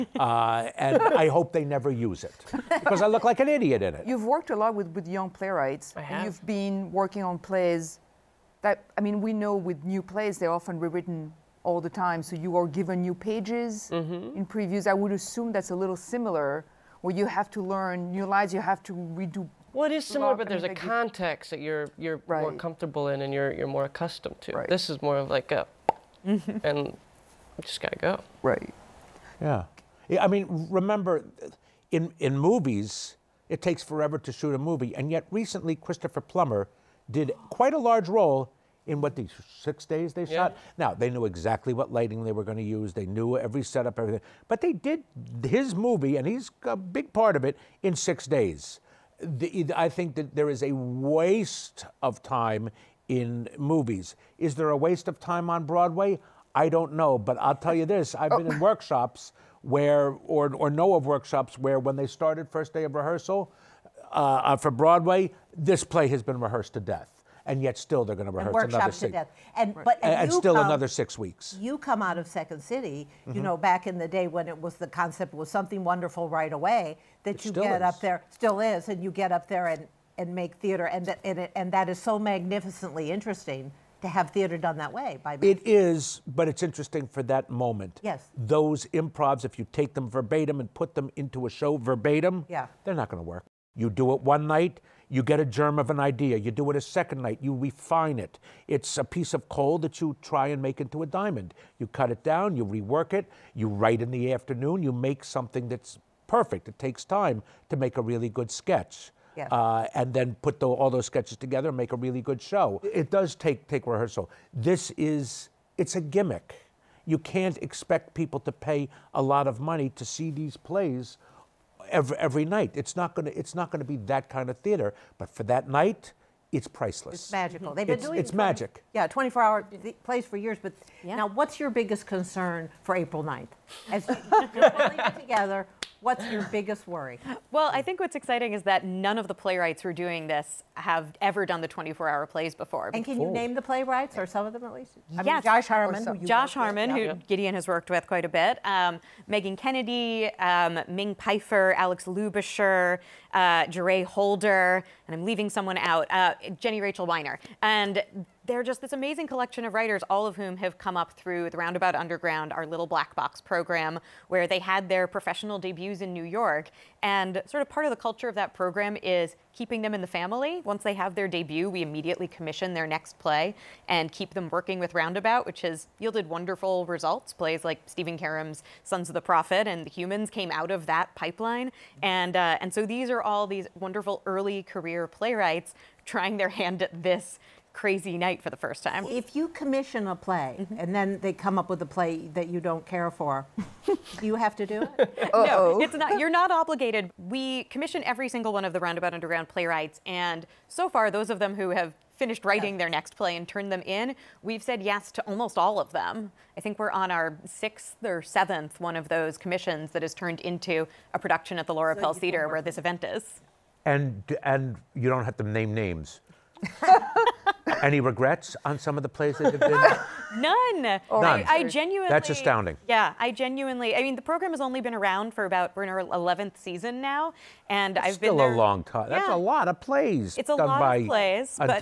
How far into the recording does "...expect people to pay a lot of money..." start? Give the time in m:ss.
1:57.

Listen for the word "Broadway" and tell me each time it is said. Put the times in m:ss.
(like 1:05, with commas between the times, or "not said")
0:55, 1:04.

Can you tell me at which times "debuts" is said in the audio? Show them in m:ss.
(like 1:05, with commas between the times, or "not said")
2:45, 2:51.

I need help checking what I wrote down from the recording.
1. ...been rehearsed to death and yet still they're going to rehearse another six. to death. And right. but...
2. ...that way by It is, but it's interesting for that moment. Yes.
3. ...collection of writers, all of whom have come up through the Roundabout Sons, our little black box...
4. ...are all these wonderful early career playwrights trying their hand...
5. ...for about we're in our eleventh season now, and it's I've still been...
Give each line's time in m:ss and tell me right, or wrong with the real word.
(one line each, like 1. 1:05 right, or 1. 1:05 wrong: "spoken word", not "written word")
1. 1:06 right
2. 1:24 right
3. 2:39 wrong: "Underground", not "Sons"
4. 3:03 right
5. 3:45 right.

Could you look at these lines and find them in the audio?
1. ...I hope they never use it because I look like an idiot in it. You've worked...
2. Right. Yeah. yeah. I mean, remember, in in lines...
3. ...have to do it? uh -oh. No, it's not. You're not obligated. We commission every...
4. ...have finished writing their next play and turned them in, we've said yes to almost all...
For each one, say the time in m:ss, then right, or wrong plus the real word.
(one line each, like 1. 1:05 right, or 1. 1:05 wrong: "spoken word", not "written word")
1. 0:01 right
2. 0:28 wrong: "movies", not "lines"
3. 3:14 right
4. 3:21 right.